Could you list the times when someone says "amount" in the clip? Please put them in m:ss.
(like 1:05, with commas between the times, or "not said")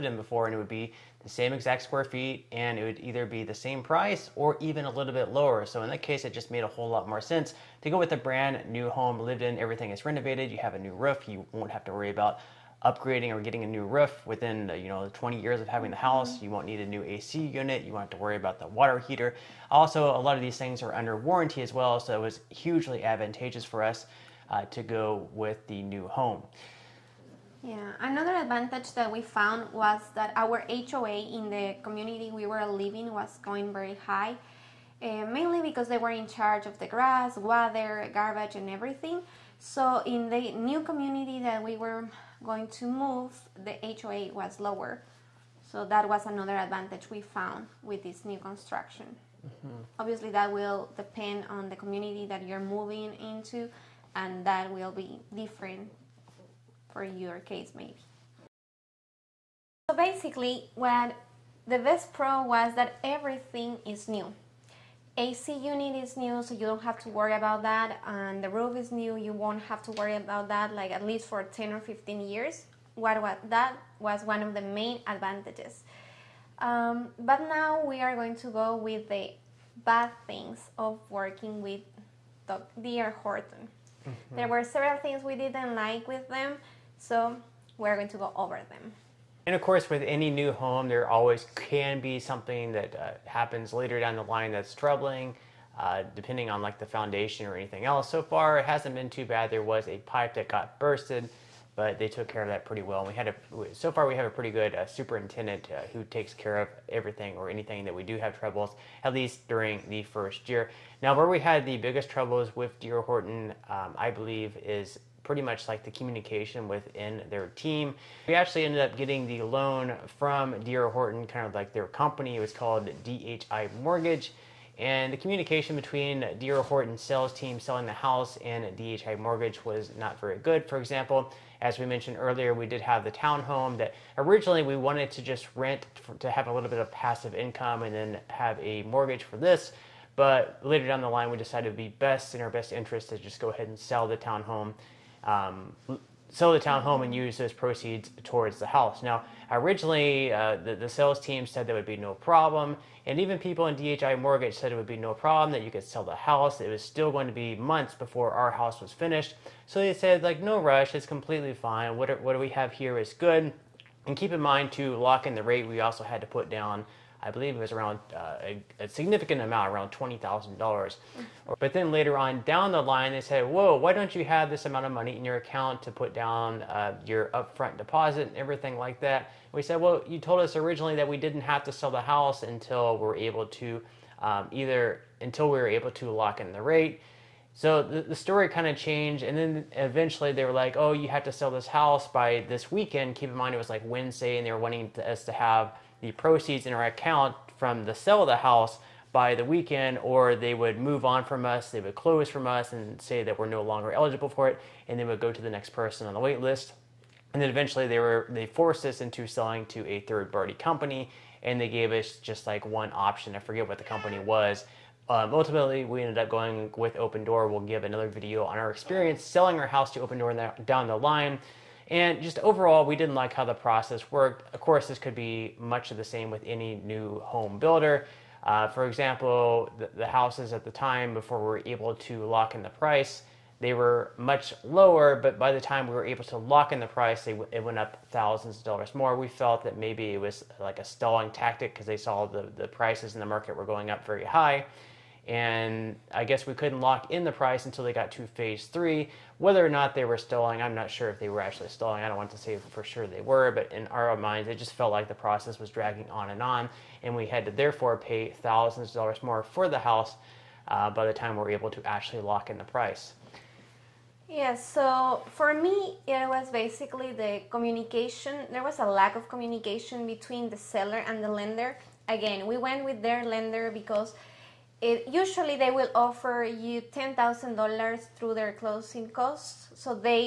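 2:49, 2:54.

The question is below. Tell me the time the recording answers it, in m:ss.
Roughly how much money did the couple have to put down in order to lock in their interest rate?
2:49.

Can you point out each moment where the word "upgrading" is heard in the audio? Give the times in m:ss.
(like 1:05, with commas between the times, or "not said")
0:12.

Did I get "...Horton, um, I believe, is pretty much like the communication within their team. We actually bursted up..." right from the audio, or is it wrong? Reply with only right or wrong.
wrong.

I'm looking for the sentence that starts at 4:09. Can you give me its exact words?
Whether or not they were stalling, I'm not sure if they were actually stalling.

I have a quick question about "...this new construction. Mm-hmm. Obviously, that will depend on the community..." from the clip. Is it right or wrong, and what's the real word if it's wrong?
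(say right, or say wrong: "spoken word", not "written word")
right.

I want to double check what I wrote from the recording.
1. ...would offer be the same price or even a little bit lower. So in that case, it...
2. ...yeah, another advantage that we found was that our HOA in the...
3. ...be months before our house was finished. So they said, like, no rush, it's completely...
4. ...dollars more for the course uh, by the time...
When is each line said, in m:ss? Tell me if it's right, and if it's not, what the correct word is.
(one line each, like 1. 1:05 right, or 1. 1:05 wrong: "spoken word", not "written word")
1. 0:02 wrong: "either", not "offer"
2. 0:27 right
3. 2:37 right
4. 4:18 wrong: "house", not "course".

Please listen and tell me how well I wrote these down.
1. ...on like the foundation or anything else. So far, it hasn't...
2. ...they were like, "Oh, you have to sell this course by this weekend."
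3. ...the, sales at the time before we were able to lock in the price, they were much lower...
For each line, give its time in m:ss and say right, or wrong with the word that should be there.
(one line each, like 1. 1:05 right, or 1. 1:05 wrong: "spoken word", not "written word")
1. 1:36 right
2. 3:10 wrong: "house", not "course"
3. 3:49 wrong: "houses", not "sales".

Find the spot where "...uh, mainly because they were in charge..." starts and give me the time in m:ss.
0:35.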